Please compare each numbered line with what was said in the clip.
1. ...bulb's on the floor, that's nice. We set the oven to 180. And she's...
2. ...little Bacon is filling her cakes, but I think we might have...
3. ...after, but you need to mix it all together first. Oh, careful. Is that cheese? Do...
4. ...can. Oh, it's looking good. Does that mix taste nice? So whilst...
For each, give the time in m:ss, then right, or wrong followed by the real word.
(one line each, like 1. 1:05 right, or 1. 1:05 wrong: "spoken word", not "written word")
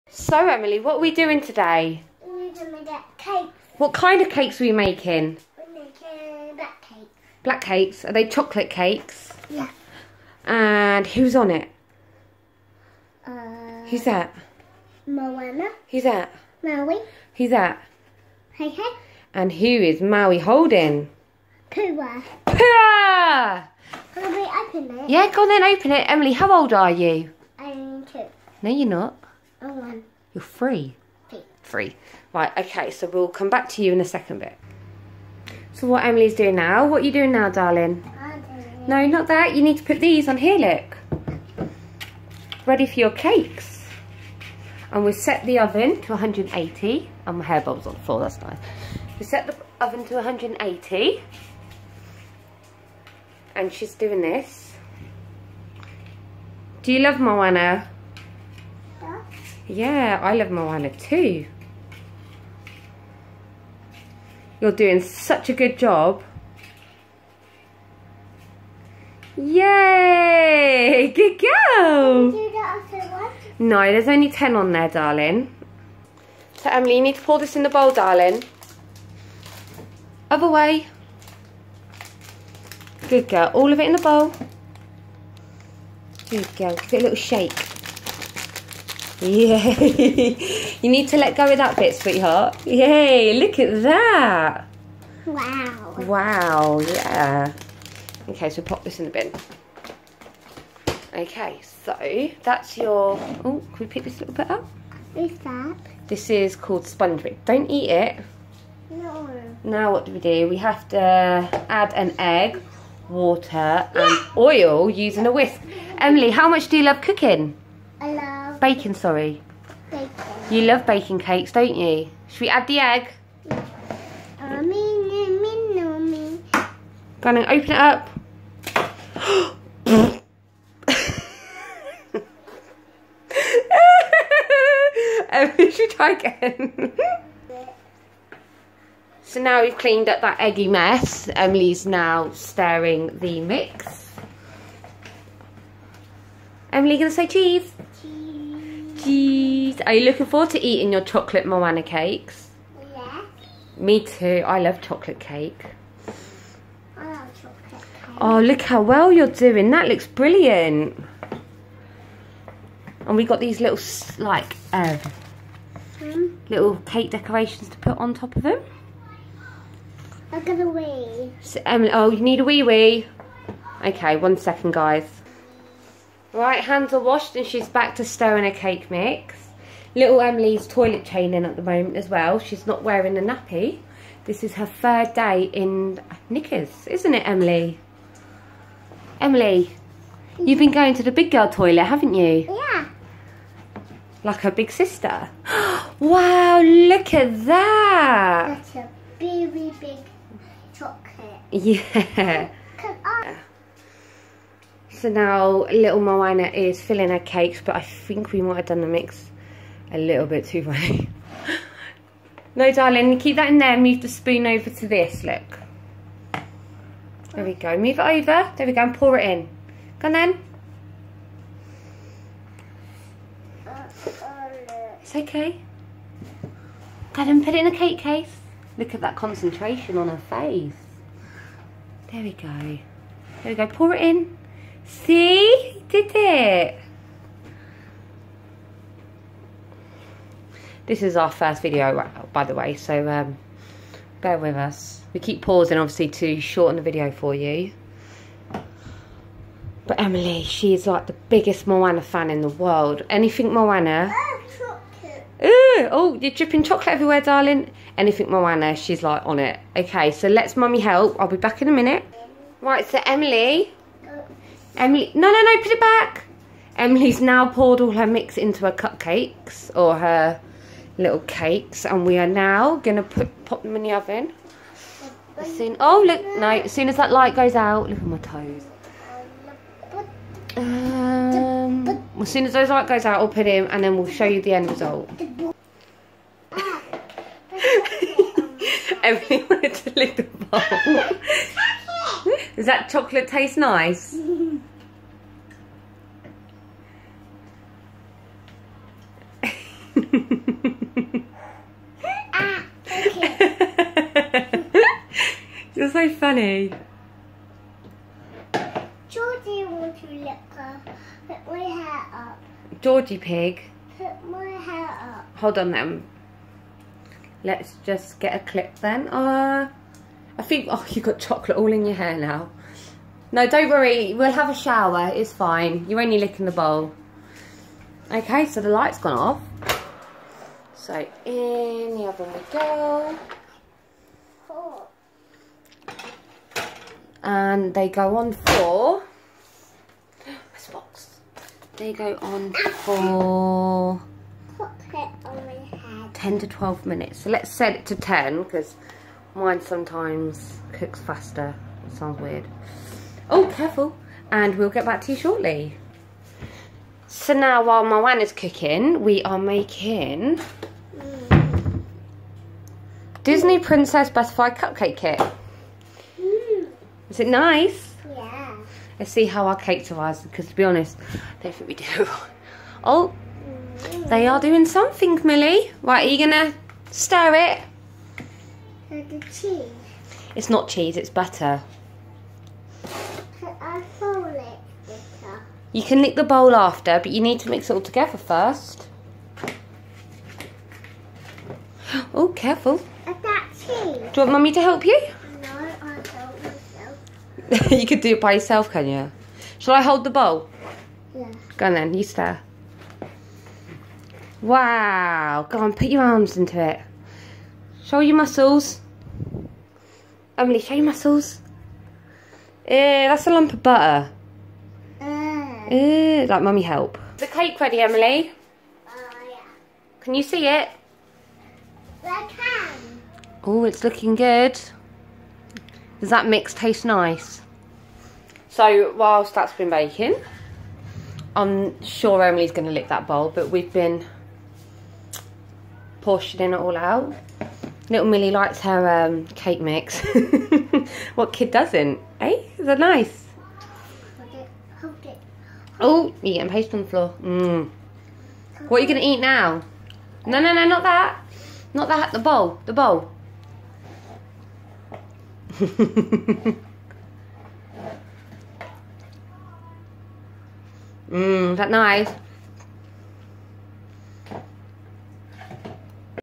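1. 0:47 right
2. 3:25 wrong: "Moana", not "Bacon"
3. 6:26 right
4. 7:02 right.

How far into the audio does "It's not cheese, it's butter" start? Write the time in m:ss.
6:20.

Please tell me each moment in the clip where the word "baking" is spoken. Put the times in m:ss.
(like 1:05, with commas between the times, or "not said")
2:00, 7:09.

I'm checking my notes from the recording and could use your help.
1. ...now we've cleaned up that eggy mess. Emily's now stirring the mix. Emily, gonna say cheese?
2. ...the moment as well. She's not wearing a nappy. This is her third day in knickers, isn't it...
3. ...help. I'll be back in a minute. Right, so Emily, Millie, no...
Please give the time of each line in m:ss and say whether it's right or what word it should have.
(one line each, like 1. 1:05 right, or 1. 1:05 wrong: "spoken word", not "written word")
1. 2:19 right
2. 3:01 right
3. 4:20 wrong: "Emily", not "Millie".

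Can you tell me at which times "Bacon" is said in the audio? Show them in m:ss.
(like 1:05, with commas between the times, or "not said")
1:58.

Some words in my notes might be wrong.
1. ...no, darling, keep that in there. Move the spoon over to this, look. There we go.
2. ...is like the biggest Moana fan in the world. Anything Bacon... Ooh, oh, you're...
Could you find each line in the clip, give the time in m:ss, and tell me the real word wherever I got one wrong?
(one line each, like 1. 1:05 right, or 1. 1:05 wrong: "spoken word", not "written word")
1. 3:32 right
2. 4:10 wrong: "Moana", not "Bacon".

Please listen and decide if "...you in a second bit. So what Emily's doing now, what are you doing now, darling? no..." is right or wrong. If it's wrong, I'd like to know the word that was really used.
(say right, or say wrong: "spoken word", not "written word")
right.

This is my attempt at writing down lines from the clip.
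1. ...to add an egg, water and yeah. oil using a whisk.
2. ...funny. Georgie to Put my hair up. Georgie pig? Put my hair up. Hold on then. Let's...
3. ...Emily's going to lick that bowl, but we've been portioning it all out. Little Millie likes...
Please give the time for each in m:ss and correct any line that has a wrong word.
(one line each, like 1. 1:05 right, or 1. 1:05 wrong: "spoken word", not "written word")
1. 1:50 right
2. 5:06 right
3. 7:12 right.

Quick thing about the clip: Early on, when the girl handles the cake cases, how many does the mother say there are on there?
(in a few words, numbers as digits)
10.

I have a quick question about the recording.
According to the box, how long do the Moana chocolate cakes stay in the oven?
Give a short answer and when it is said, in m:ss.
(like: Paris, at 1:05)
10 to 12 minutes, at 5:46.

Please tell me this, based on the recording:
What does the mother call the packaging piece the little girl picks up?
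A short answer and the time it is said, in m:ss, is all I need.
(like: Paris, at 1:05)
sponge bit, at 1:46.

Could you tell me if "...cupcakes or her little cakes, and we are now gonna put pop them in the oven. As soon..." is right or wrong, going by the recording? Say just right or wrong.
right.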